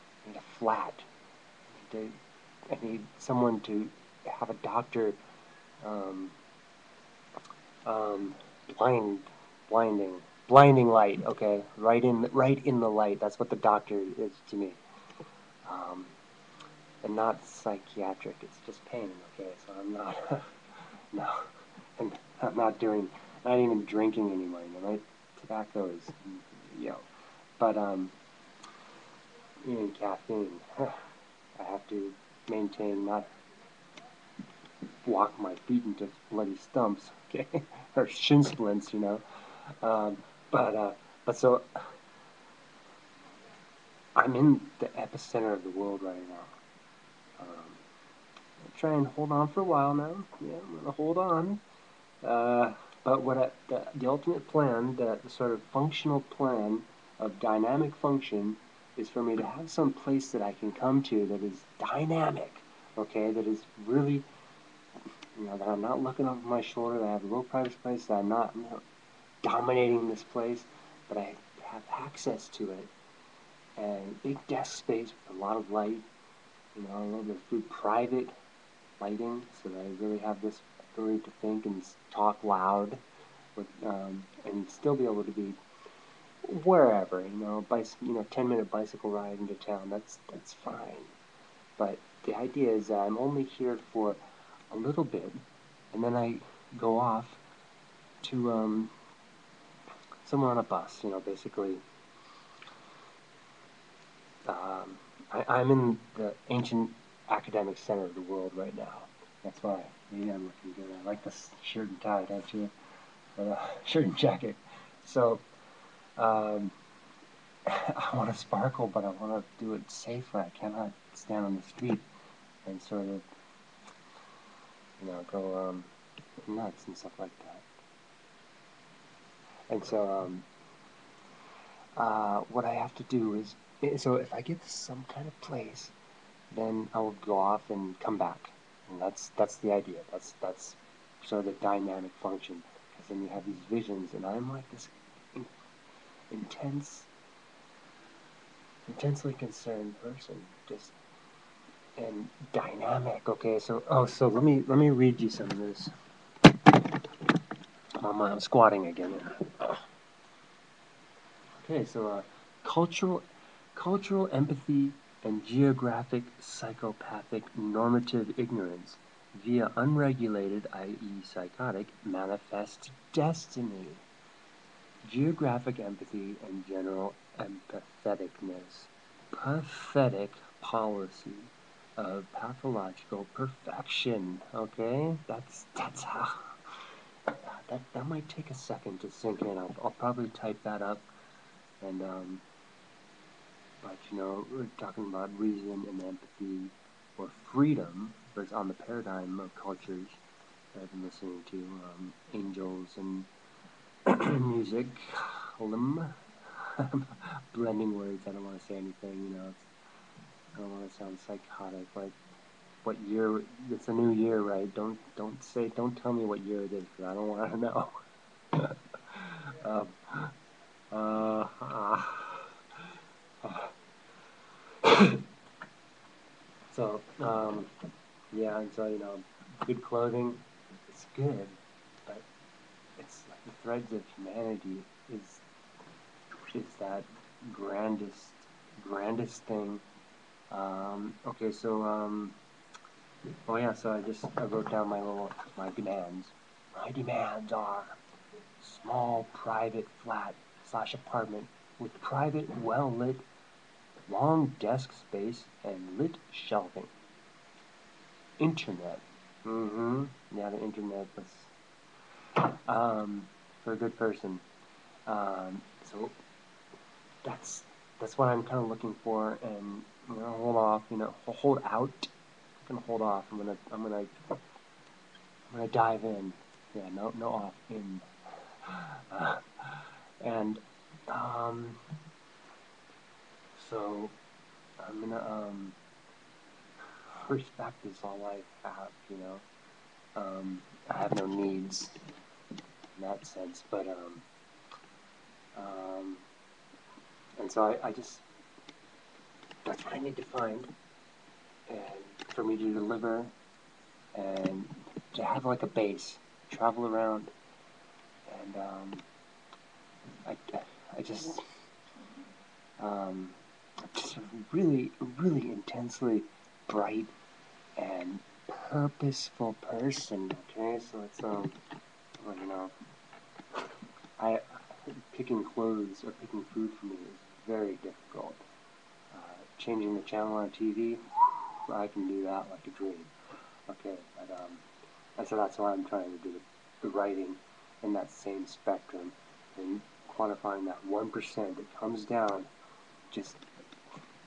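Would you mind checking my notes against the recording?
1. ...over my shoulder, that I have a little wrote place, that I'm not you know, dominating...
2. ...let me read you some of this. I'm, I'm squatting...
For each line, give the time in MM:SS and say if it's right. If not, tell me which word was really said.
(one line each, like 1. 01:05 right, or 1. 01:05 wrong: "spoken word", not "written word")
1. 01:06 wrong: "private", not "wrote"
2. 02:34 right.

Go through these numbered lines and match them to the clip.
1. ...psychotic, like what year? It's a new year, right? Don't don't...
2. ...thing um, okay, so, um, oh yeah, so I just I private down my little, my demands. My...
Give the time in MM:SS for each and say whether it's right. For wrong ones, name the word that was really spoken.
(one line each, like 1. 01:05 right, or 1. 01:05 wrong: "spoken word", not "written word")
1. 03:31 right
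2. 03:59 wrong: "wrote", not "private".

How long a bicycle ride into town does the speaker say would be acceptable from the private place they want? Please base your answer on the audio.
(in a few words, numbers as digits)
10 minutes.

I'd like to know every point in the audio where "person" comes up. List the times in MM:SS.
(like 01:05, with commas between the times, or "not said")
02:30, 04:23, 05:19.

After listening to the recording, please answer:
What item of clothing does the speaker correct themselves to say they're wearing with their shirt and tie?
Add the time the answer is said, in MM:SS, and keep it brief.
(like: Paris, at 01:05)
jacket, at 01:54.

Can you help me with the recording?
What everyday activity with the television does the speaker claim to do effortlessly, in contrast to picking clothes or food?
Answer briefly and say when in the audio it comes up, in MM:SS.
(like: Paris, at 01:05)
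changing the channel, at 05:29.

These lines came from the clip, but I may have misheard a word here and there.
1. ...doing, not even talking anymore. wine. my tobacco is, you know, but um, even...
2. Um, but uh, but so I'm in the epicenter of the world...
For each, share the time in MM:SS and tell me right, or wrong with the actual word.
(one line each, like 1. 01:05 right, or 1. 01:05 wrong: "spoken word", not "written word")
1. 00:22 wrong: "drinking", not "talking"
2. 00:39 right.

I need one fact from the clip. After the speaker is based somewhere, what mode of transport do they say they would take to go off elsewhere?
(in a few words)
bus.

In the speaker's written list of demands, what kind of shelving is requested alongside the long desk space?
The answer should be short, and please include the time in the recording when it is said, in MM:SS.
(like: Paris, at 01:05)
lit shelving, at 04:15.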